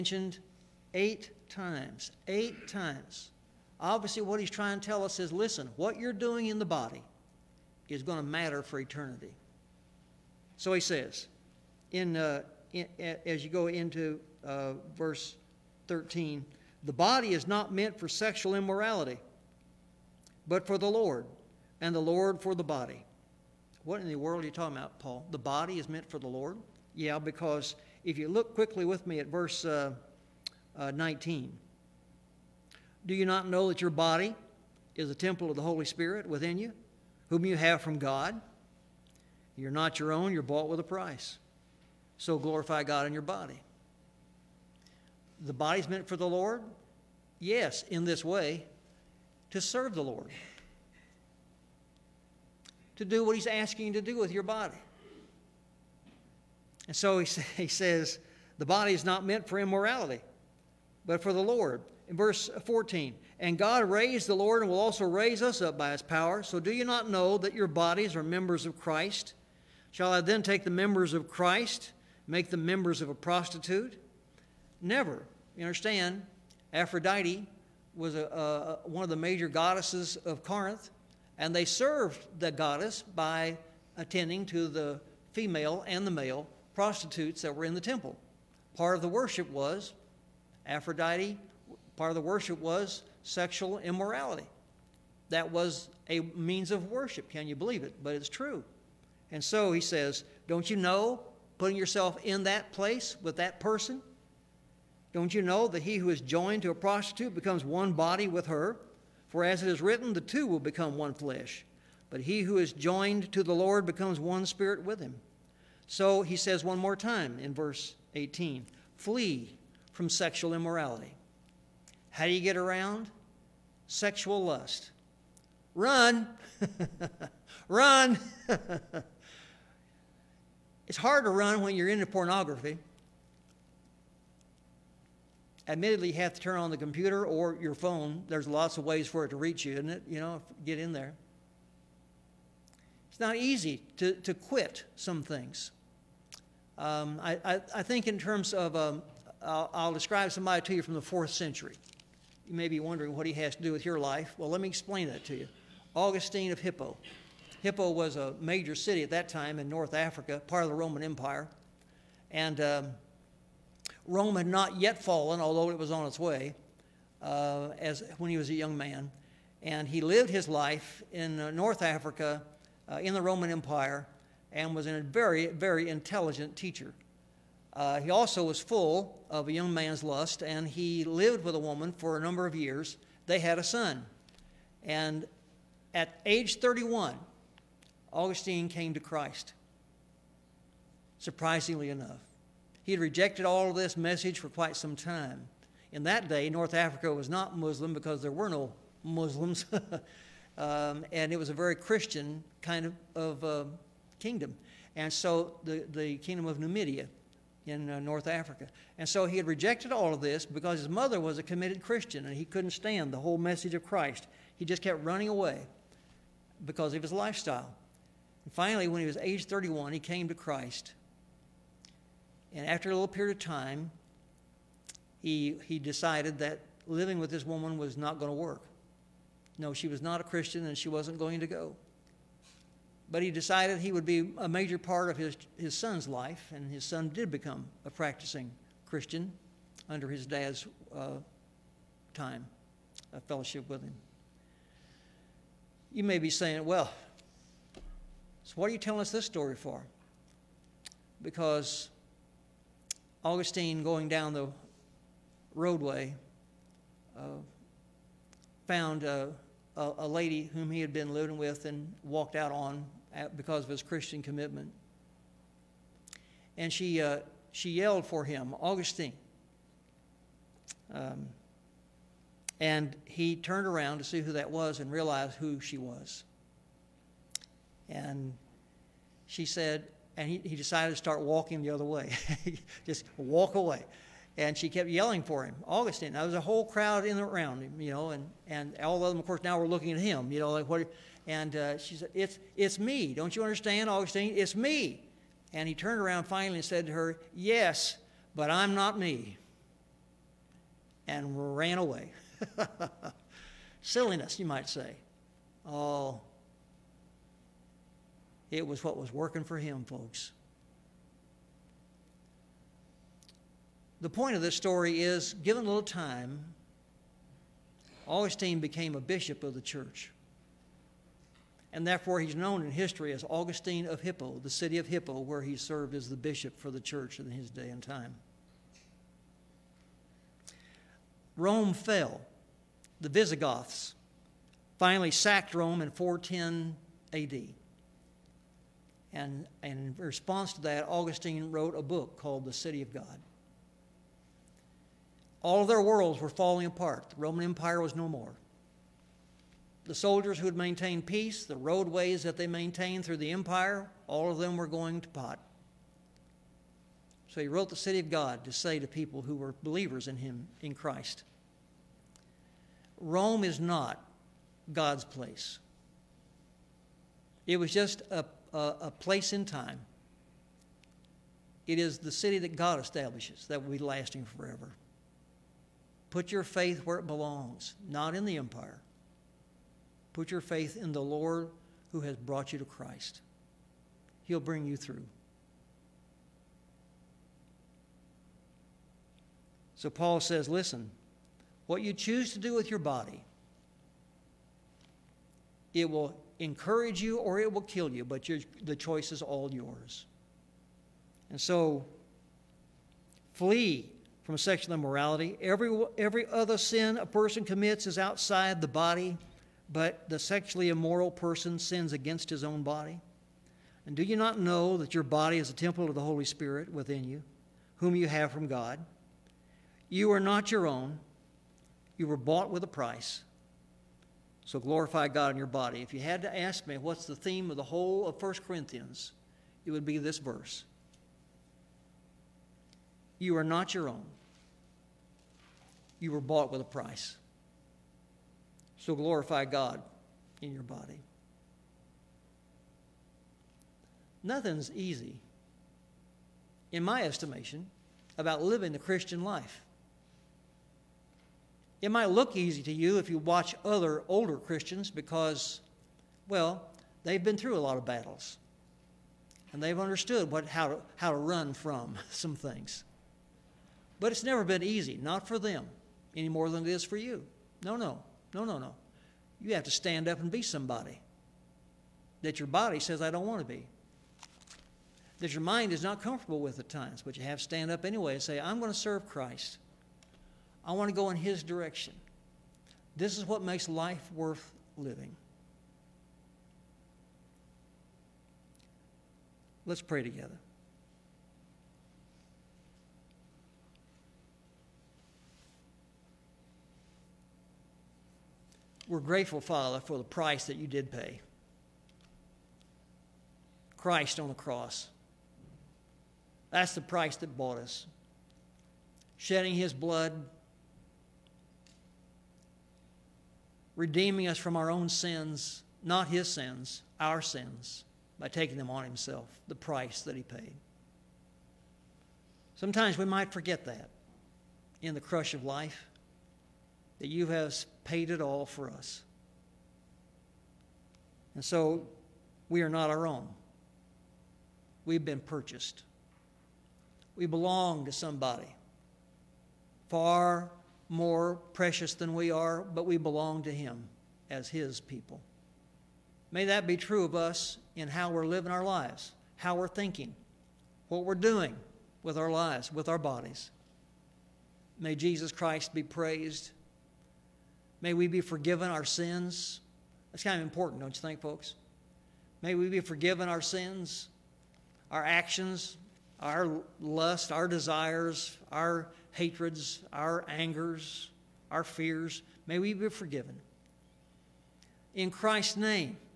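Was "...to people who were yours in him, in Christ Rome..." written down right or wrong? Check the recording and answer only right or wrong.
wrong.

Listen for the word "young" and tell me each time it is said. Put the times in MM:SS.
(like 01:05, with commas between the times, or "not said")
02:48, 02:59.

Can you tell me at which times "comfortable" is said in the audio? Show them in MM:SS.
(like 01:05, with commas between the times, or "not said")
07:56.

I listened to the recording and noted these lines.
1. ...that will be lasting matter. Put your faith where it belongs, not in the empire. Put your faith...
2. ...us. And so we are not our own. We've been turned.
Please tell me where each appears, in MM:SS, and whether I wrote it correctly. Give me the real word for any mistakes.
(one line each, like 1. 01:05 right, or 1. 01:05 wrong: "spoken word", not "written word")
1. 06:13 wrong: "forever", not "matter"
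2. 08:48 wrong: "purchased", not "turned".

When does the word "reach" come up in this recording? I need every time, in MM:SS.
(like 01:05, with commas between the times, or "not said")
02:19.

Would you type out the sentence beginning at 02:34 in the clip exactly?
Well, let me explain that to you.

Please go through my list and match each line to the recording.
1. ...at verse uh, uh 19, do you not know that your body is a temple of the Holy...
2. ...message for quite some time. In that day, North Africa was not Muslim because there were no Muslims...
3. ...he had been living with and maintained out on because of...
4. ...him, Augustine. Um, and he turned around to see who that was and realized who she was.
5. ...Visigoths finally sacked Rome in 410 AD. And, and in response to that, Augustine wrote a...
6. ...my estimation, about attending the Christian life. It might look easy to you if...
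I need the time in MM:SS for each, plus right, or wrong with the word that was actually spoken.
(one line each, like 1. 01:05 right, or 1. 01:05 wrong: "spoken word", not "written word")
1. 00:29 right
2. 03:13 right
3. 04:20 wrong: "walked", not "maintained"
4. 04:28 right
5. 05:33 right
6. 07:26 wrong: "living", not "attending".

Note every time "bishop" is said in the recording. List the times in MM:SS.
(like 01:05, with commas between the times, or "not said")
05:19, 05:26.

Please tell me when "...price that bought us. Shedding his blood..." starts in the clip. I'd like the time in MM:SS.
08:26.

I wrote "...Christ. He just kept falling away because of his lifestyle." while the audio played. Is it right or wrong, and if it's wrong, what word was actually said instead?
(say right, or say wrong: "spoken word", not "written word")
wrong: "running", not "falling".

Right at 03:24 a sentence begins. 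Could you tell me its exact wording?
And so the, the kingdom of Numidia in uh, North Africa.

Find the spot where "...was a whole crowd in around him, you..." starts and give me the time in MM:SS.
04:46.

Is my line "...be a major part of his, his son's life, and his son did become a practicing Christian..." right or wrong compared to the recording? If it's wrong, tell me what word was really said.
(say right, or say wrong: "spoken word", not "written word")
right.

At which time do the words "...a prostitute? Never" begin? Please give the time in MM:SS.
01:13.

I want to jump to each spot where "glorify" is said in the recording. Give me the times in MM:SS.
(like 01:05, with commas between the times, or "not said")
00:42, 07:04, 07:18.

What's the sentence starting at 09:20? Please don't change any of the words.
That's kind of important, don't you think, folks?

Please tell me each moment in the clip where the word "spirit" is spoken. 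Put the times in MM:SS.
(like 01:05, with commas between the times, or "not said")
00:35, 01:54, 06:56.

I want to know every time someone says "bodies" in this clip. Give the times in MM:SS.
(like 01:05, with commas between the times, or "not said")
01:07, 09:12.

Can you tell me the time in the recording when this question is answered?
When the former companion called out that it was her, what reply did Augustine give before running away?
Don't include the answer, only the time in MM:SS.
04:57.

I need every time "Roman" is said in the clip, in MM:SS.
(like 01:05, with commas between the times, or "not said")
02:40, 02:53, 05:47.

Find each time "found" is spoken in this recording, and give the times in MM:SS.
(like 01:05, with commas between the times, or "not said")
04:18.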